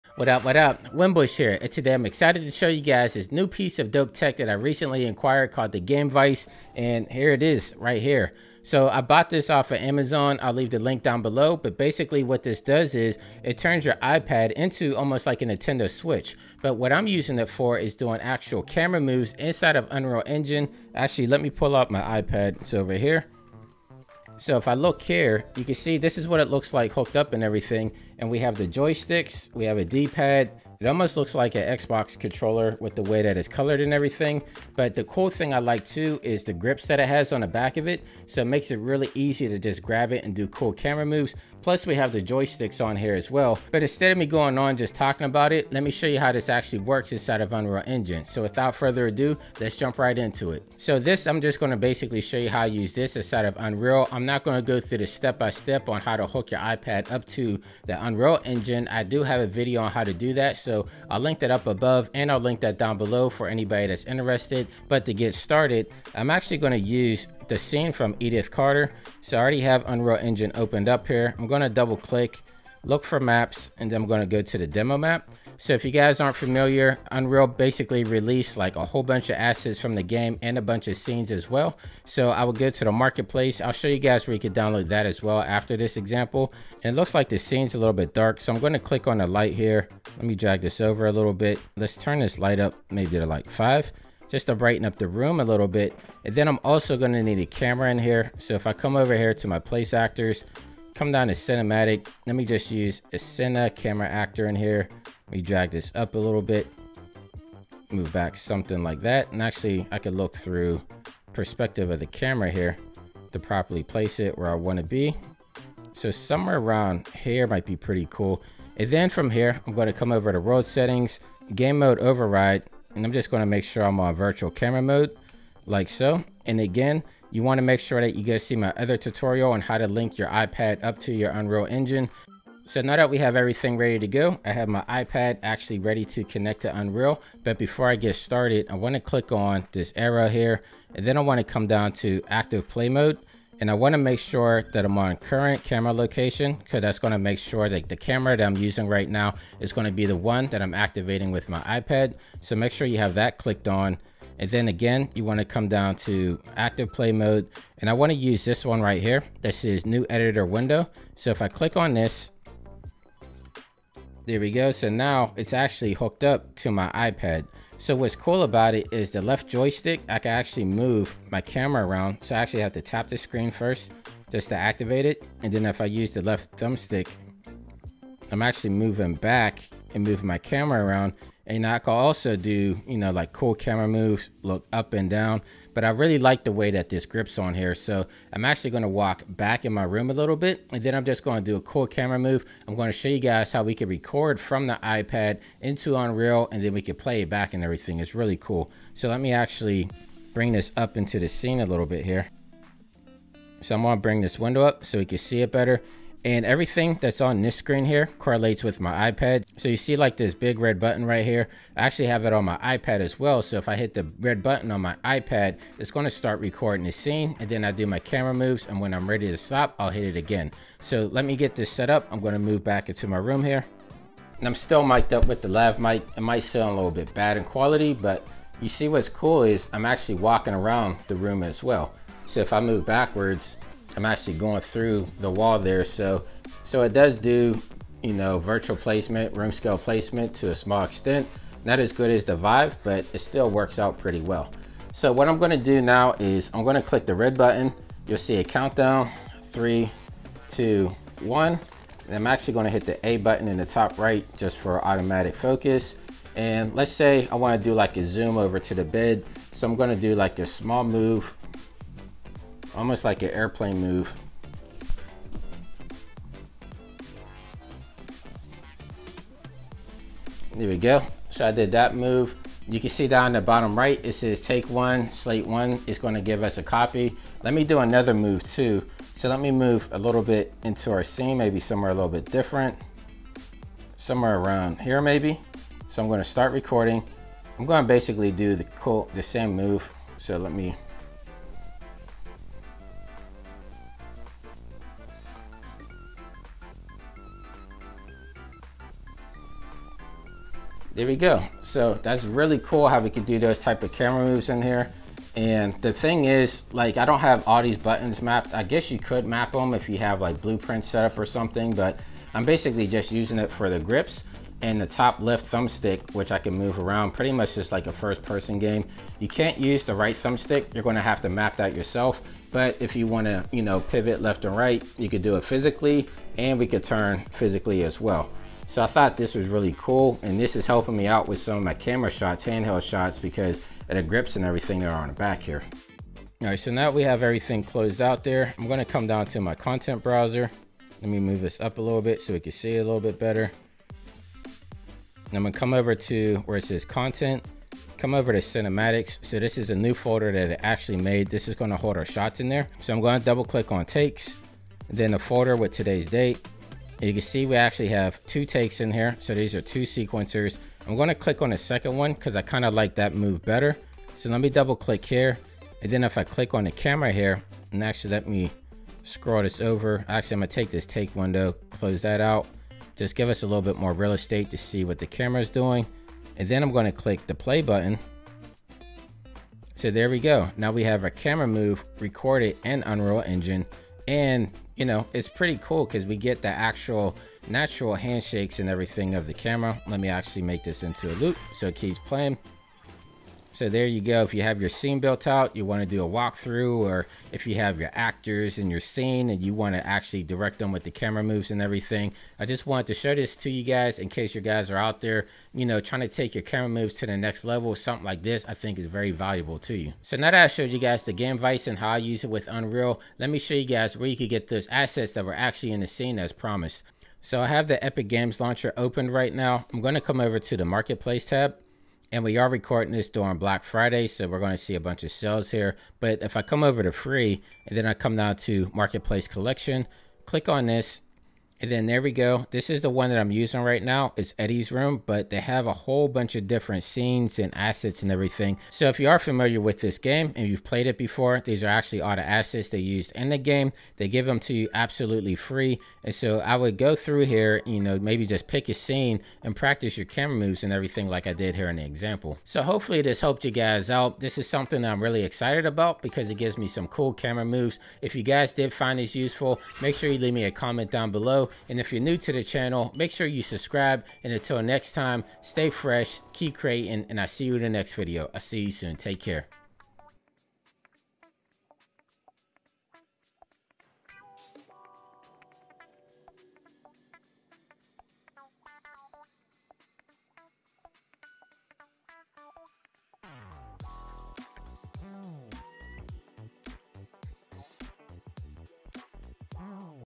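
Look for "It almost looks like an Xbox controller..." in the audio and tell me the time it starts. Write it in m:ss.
0:30.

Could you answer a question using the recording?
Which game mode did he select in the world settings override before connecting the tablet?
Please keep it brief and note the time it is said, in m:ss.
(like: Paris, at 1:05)
virtual camera mode, at 2:04.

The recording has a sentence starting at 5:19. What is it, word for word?
You can't use the right thumbstick.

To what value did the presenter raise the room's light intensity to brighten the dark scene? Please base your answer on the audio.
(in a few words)
5.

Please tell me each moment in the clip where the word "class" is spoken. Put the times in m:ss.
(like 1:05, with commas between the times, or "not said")
not said.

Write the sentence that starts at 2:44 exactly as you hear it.
So now it's actually hooked up to my iPad.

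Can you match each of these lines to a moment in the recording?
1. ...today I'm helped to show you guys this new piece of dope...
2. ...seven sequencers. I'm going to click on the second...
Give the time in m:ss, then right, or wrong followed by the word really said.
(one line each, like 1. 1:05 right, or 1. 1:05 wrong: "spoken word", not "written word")
1. 0:01 wrong: "excited", not "helped"
2. 5:59 wrong: "two", not "seven".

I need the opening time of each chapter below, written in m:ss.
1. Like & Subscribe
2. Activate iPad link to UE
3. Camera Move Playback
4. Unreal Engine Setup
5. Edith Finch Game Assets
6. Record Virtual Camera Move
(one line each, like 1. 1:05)
1. 7:33
2. 2:43
3. 5:40
4. 0:50
5. 6:58
6. 4:08.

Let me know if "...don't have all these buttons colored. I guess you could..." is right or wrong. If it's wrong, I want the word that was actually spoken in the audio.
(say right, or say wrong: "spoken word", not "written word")
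wrong: "mapped", not "colored".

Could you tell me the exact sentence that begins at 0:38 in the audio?
So it makes it really easy to just grab it and do cool camera moves.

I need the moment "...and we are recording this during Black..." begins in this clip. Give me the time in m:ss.
7:02.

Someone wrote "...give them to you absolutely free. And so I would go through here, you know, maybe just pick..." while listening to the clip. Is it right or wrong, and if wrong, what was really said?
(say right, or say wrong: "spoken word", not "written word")
right.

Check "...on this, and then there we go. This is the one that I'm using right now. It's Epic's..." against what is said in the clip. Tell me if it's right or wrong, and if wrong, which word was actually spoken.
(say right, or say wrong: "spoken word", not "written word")
wrong: "Eddie", not "Epic".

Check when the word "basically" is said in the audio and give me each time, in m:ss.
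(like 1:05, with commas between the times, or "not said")
0:11, 0:51, 1:17, 4:47, 5:12.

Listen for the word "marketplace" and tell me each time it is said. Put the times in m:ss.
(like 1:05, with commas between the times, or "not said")
1:22, 7:00, 7:08.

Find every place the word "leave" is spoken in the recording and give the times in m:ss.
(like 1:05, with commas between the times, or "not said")
0:10, 7:40.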